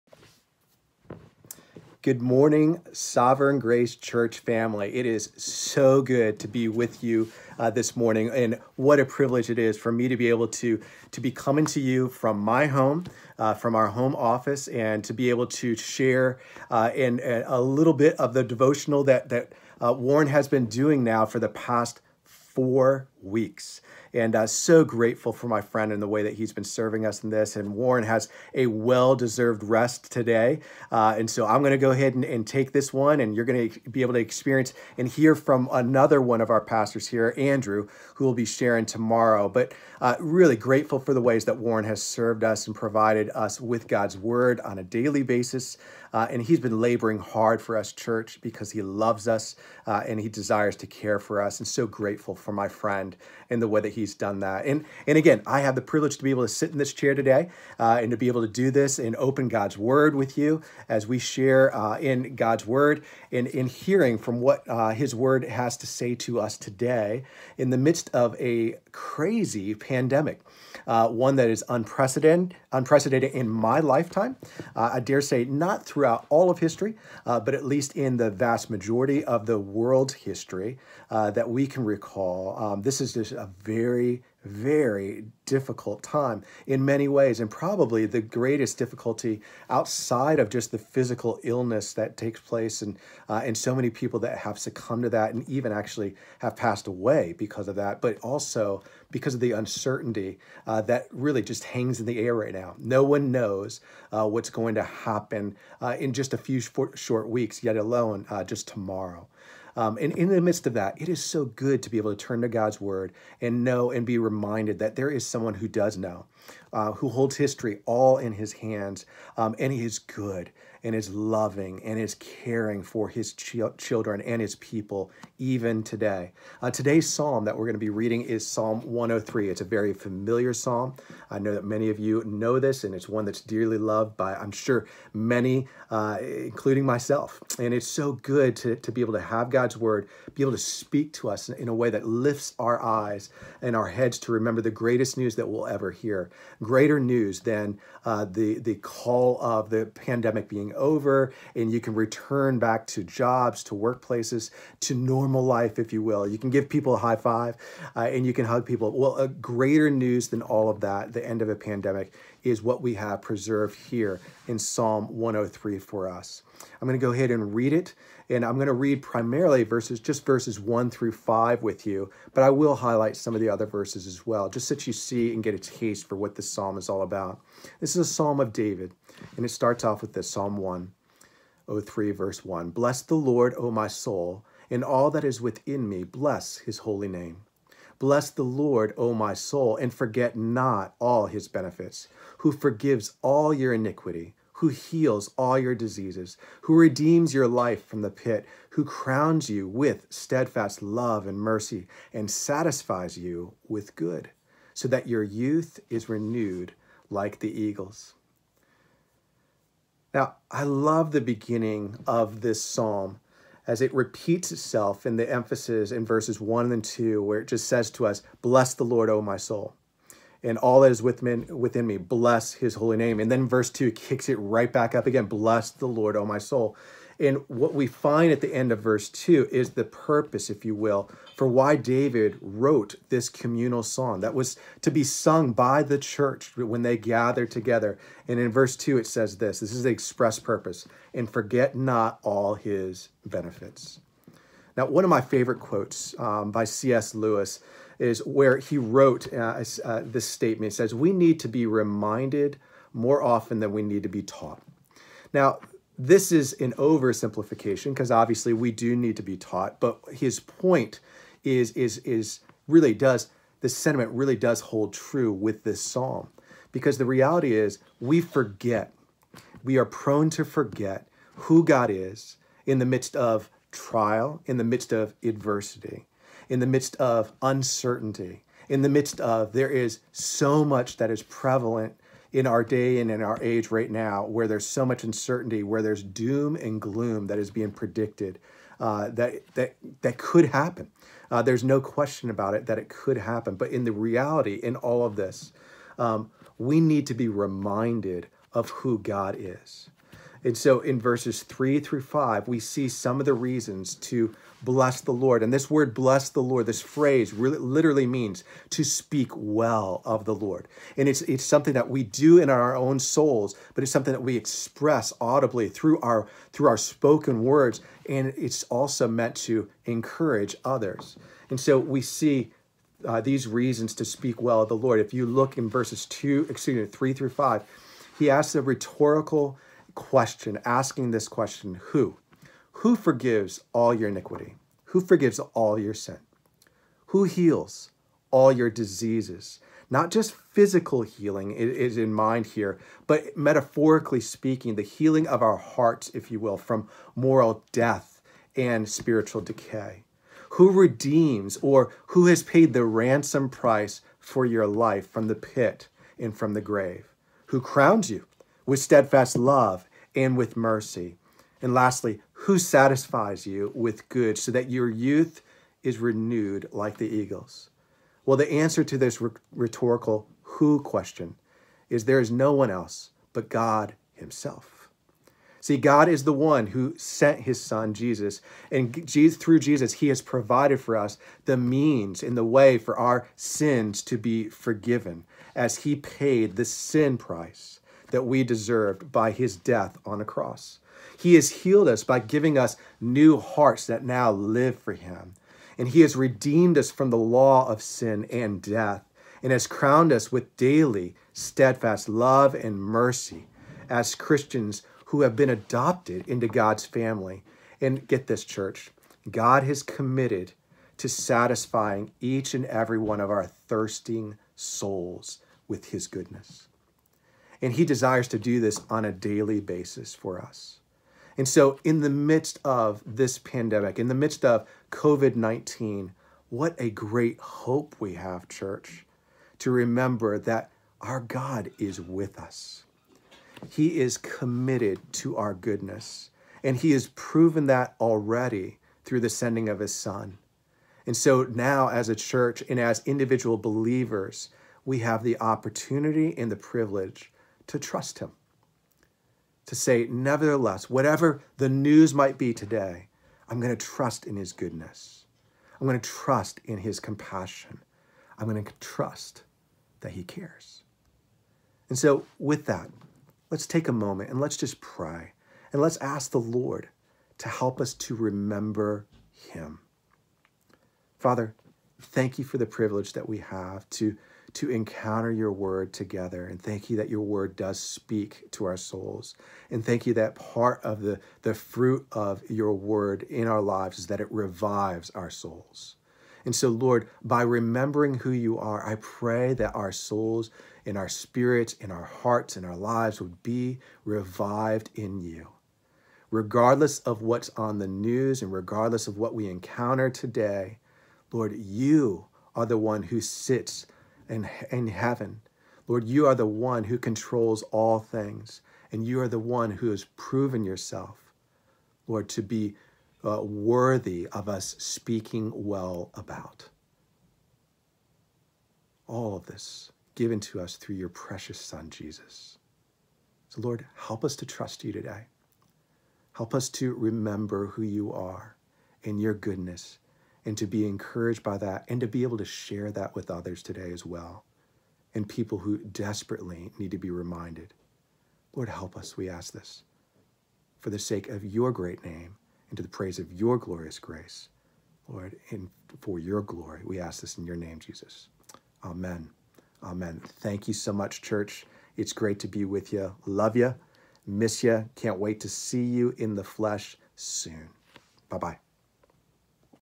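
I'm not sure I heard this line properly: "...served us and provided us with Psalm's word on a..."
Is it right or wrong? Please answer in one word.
wrong.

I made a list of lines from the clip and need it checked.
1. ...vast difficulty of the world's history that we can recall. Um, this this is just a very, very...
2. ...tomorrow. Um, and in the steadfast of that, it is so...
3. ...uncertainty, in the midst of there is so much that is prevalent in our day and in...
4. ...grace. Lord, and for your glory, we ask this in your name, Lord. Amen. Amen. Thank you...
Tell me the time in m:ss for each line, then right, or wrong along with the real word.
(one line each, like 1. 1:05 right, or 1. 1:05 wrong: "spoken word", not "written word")
1. 1:18 wrong: "majority", not "difficulty"
2. 1:48 wrong: "midst", not "steadfast"
3. 4:37 right
4. 9:03 wrong: "Jesus", not "Lord".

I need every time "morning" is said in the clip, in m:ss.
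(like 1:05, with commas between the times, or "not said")
0:02, 0:07.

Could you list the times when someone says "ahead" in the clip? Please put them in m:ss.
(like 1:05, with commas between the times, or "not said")
0:31, 2:47.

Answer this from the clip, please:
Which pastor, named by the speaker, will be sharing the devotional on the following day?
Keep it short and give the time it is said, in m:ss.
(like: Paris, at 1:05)
Andrew, at 0:37.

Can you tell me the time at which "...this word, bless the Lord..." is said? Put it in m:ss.
5:05.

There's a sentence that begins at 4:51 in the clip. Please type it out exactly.
Uh, there's no question about it that it could happen.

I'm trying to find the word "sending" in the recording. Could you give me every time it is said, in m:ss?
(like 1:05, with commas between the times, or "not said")
7:19.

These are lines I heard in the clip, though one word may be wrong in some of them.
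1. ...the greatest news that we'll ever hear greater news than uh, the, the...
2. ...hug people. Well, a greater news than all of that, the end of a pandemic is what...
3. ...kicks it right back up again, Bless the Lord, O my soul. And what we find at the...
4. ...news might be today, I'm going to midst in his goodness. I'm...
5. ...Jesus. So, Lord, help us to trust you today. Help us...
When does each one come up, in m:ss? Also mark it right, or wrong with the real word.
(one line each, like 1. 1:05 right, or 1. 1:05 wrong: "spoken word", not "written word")
1. 2:24 right
2. 2:38 right
3. 3:43 right
4. 7:31 wrong: "trust", not "midst"
5. 8:41 right.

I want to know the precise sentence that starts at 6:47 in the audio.
And get this, church, God has committed to satisfying each and every one of our thirsting souls with his goodness.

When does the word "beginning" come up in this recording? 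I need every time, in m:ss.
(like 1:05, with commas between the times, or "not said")
3:31.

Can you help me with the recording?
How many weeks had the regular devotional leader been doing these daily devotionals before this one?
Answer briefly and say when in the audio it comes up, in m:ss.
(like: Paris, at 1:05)
four weeks, at 0:22.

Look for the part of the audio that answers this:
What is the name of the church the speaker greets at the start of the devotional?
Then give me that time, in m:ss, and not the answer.
0:02.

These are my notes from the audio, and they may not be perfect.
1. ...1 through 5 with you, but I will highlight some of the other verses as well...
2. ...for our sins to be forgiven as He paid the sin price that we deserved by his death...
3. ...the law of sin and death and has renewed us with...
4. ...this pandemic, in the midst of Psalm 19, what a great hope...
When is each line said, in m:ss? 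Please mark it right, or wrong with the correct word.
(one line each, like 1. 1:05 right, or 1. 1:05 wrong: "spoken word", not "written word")
1. 2:50 right
2. 6:22 right
3. 6:37 wrong: "crowned", not "renewed"
4. 7:03 wrong: "COVID", not "Psalm".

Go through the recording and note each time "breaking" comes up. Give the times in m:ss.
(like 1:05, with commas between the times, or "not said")
not said.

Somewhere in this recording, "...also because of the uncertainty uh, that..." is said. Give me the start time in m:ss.
1:38.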